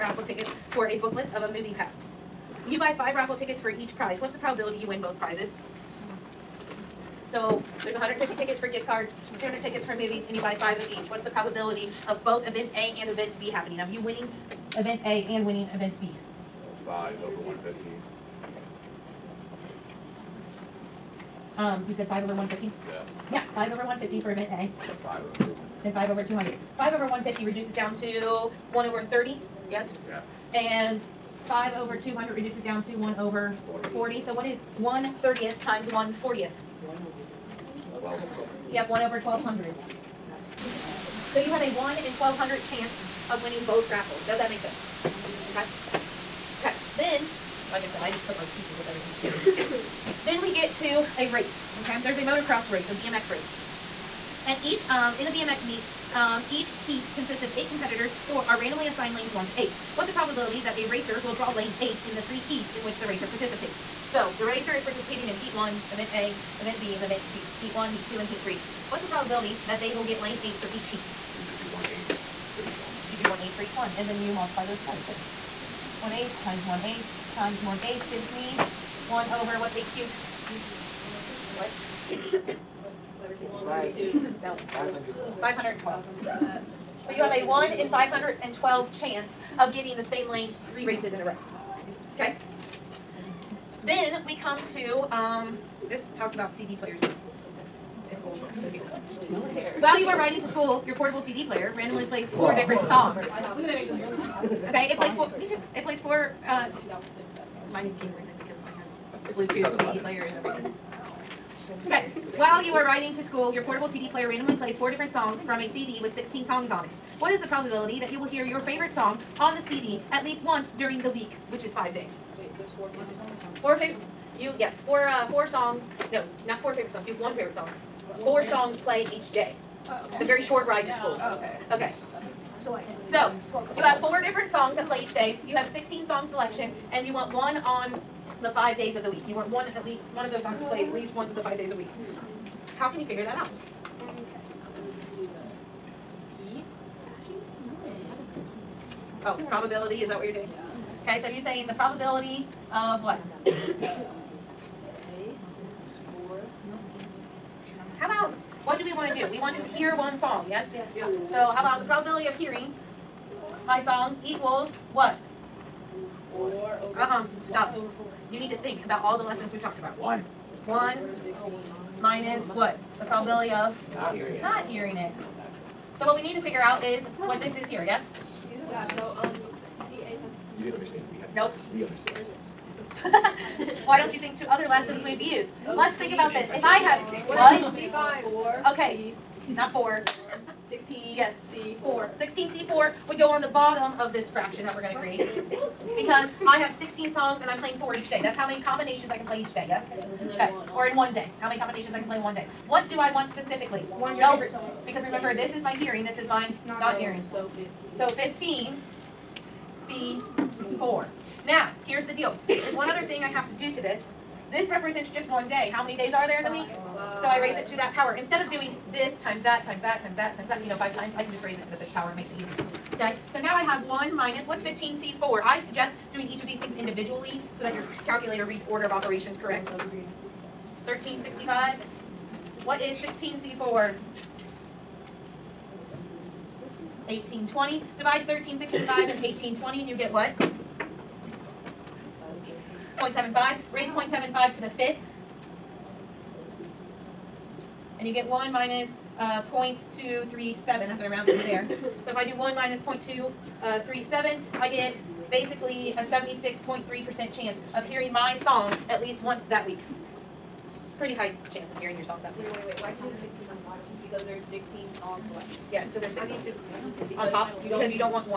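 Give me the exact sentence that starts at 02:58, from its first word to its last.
Yeah, so, um, P A You didn't understand.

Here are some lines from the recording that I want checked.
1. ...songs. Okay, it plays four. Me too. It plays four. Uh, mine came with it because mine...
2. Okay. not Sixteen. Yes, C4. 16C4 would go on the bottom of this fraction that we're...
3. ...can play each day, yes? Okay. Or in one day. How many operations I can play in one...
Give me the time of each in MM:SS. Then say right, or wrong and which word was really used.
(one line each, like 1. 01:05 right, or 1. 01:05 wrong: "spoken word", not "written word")
1. 01:42 right
2. 03:08 right
3. 03:19 wrong: "combinations", not "operations".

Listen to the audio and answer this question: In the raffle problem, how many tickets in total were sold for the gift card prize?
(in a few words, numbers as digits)
150.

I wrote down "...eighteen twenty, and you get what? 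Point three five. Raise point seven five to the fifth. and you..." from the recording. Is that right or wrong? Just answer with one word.
wrong.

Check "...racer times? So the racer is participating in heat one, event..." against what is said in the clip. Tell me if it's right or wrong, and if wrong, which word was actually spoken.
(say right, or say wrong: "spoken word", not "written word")
wrong: "participates", not "times".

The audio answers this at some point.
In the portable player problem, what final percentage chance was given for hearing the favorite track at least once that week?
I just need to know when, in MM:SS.
04:16.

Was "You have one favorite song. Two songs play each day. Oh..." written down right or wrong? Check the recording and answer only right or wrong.
wrong.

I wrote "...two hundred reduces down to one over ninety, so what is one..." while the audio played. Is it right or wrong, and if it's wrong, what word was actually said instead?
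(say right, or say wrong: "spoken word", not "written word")
wrong: "forty", not "ninety".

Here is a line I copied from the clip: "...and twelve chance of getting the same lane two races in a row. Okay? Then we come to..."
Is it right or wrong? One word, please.
wrong.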